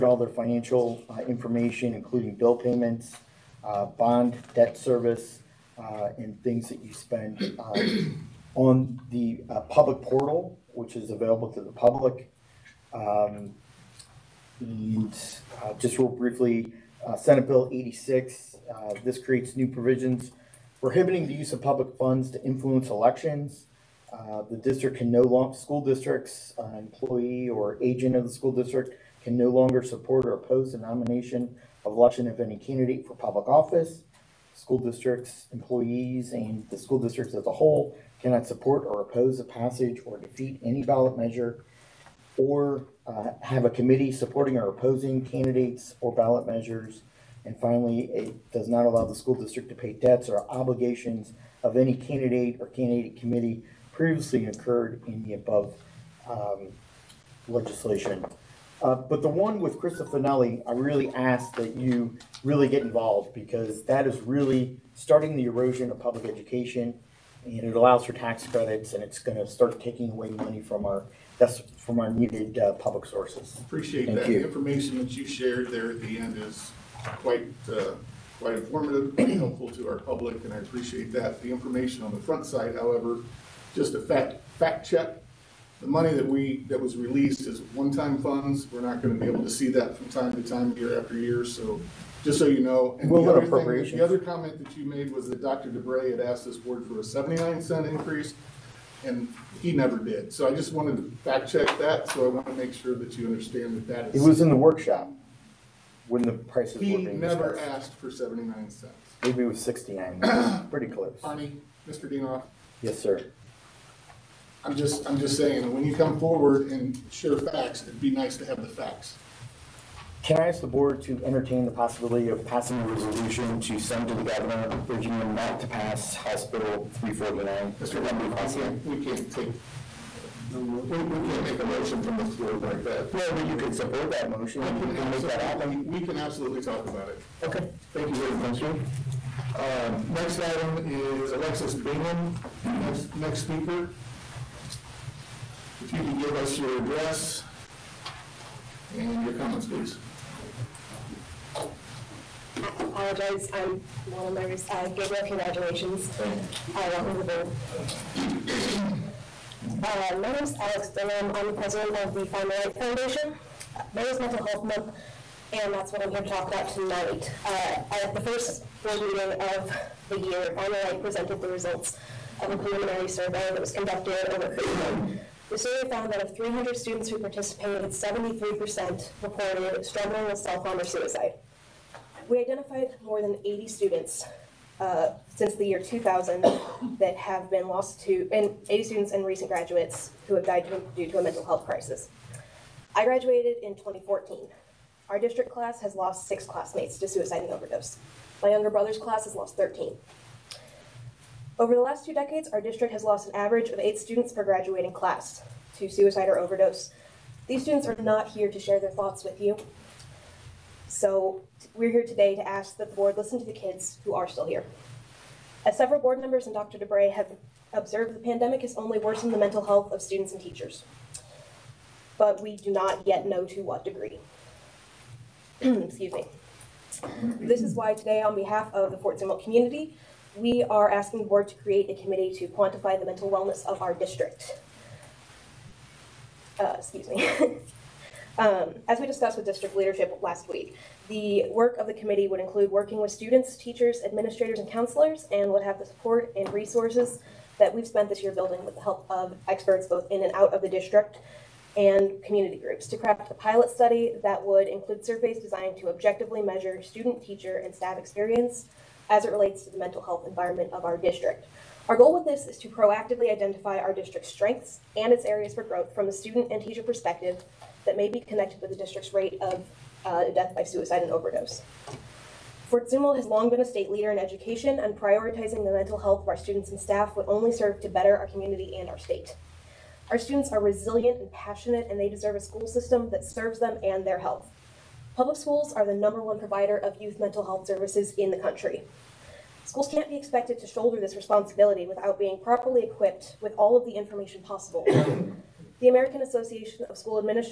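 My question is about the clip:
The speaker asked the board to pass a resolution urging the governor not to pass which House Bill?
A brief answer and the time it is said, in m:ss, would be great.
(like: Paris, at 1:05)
House Bill 349, at 2:06.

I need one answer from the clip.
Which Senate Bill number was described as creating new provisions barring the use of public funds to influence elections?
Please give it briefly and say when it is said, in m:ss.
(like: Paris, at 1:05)
86, at 0:17.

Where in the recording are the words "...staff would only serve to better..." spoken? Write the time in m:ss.
4:36.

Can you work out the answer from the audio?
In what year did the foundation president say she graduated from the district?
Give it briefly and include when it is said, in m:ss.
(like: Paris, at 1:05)
2014, at 3:13.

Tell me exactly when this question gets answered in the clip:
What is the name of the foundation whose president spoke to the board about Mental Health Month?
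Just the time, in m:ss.
2:42.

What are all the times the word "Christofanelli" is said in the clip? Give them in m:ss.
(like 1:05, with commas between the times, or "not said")
0:59.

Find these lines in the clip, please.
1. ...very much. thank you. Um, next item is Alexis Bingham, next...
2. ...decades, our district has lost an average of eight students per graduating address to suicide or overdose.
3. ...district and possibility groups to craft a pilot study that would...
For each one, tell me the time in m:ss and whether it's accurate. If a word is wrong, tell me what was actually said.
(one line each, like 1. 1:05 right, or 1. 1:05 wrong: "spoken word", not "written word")
1. 2:18 right
2. 3:22 wrong: "class", not "address"
3. 4:10 wrong: "community", not "possibility".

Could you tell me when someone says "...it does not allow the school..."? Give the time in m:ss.
0:48.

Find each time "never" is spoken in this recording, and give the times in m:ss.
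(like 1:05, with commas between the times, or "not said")
1:39, 1:46.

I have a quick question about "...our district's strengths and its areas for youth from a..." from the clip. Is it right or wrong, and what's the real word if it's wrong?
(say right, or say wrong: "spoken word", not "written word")
wrong: "growth", not "youth".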